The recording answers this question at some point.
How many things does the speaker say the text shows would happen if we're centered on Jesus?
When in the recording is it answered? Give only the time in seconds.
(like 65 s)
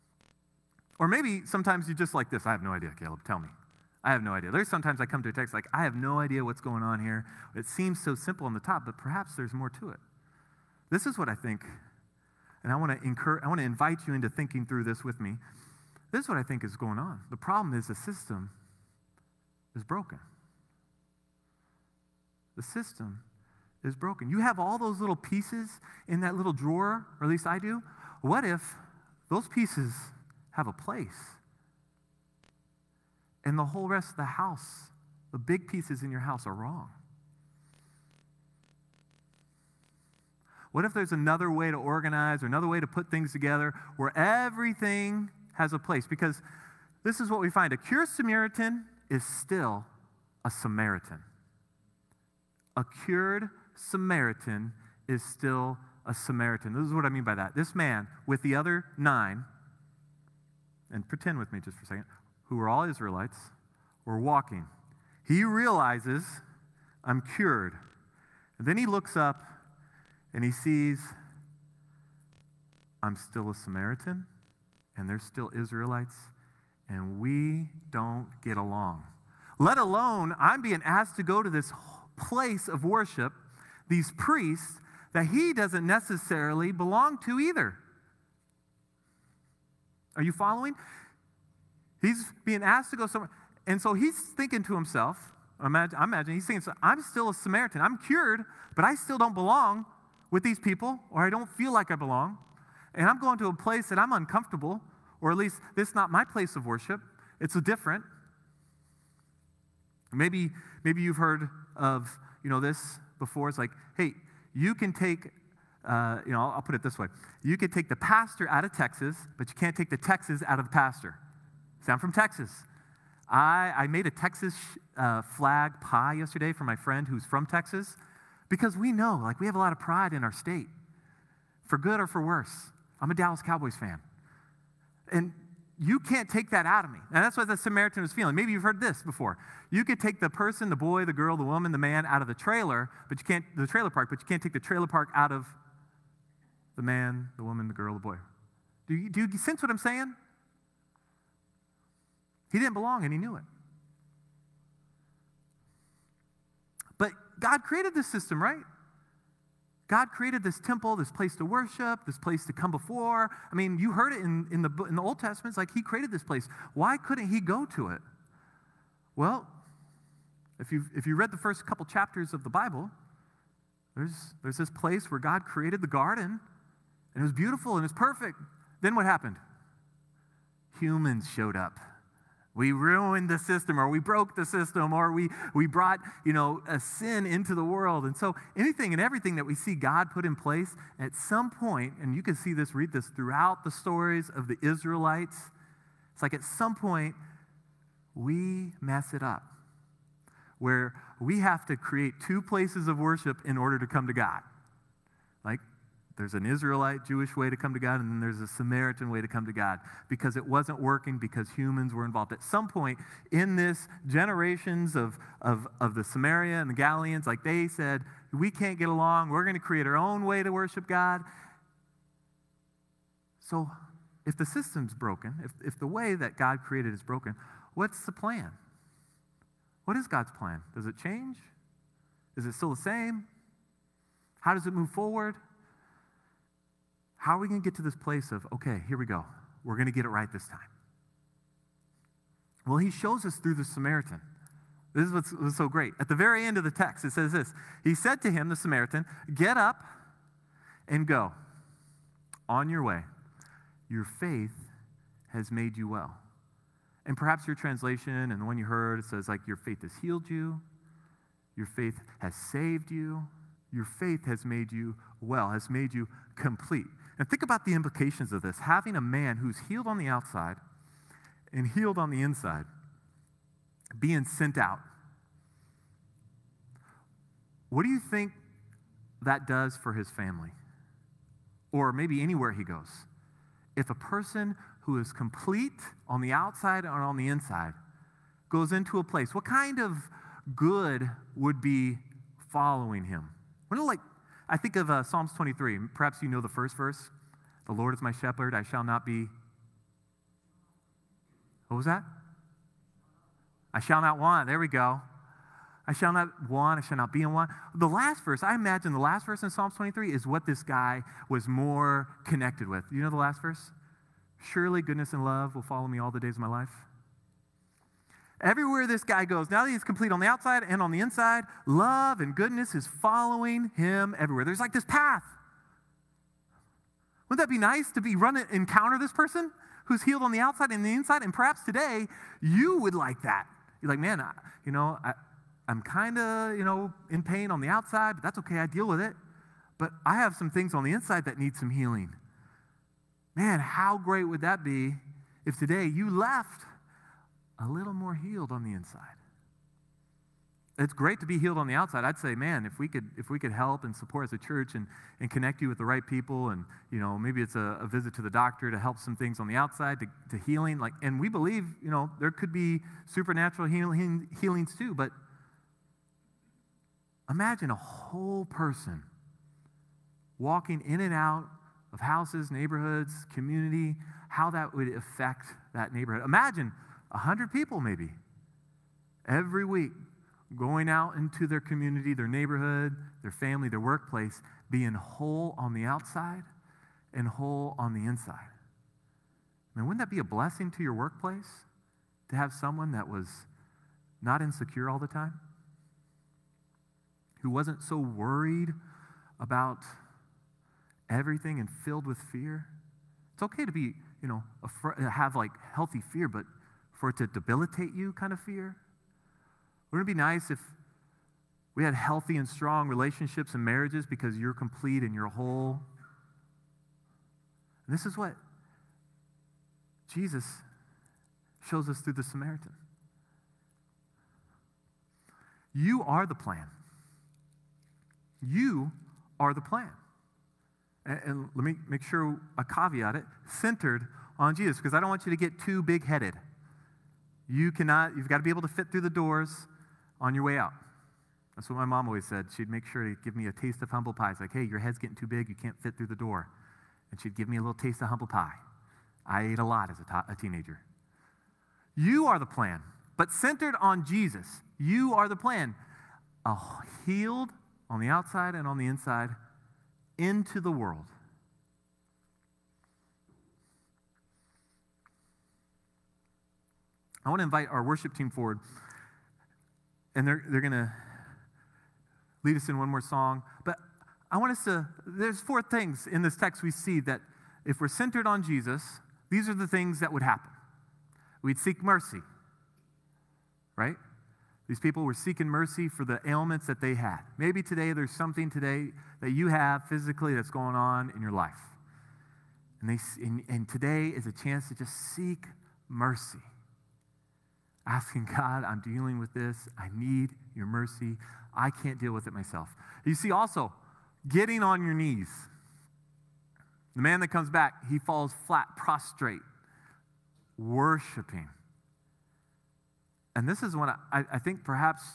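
475 s.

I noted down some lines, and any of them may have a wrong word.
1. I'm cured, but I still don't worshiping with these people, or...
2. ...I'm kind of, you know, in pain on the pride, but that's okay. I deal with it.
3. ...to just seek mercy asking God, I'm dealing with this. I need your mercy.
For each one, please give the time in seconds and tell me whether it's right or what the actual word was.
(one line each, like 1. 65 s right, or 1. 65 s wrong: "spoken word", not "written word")
1. 97 s wrong: "belong", not "worshiping"
2. 335 s wrong: "outside", not "pride"
3. 494 s right.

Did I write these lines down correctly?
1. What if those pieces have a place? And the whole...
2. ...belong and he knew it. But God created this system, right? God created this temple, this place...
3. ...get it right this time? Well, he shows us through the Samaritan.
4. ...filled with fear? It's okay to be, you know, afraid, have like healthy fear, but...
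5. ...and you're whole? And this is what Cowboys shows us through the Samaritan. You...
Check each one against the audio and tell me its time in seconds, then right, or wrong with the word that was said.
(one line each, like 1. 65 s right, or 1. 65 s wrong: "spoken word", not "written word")
1. 28 s right
2. 152 s right
3. 239 s right
4. 401 s right
5. 415 s wrong: "Jesus", not "Cowboys".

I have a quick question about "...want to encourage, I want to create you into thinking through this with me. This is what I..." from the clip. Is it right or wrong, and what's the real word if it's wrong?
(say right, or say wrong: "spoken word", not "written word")
wrong: "invite", not "create".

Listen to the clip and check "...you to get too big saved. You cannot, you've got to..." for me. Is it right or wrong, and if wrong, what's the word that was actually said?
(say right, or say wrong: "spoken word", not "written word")
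wrong: "headed", not "saved".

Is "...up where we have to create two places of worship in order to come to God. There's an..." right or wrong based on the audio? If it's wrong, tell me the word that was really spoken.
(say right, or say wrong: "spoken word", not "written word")
right.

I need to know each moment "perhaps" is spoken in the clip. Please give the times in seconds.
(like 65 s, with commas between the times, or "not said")
8 s, 257 s, 295 s, 331 s, 514 s.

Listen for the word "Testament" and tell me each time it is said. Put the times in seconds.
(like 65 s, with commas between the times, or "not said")
165 s.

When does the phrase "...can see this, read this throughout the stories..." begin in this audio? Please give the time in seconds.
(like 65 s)
192 s.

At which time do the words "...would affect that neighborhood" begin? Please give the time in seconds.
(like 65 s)
374 s.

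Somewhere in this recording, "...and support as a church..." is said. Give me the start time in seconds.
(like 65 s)
353 s.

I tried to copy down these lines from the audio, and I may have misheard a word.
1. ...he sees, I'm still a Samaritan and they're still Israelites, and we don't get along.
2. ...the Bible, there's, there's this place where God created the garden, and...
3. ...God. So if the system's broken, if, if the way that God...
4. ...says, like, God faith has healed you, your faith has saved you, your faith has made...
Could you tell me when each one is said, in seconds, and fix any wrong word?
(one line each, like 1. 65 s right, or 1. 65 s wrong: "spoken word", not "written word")
1. 70 s right
2. 172 s right
3. 220 s right
4. 259 s wrong: "Your", not "God".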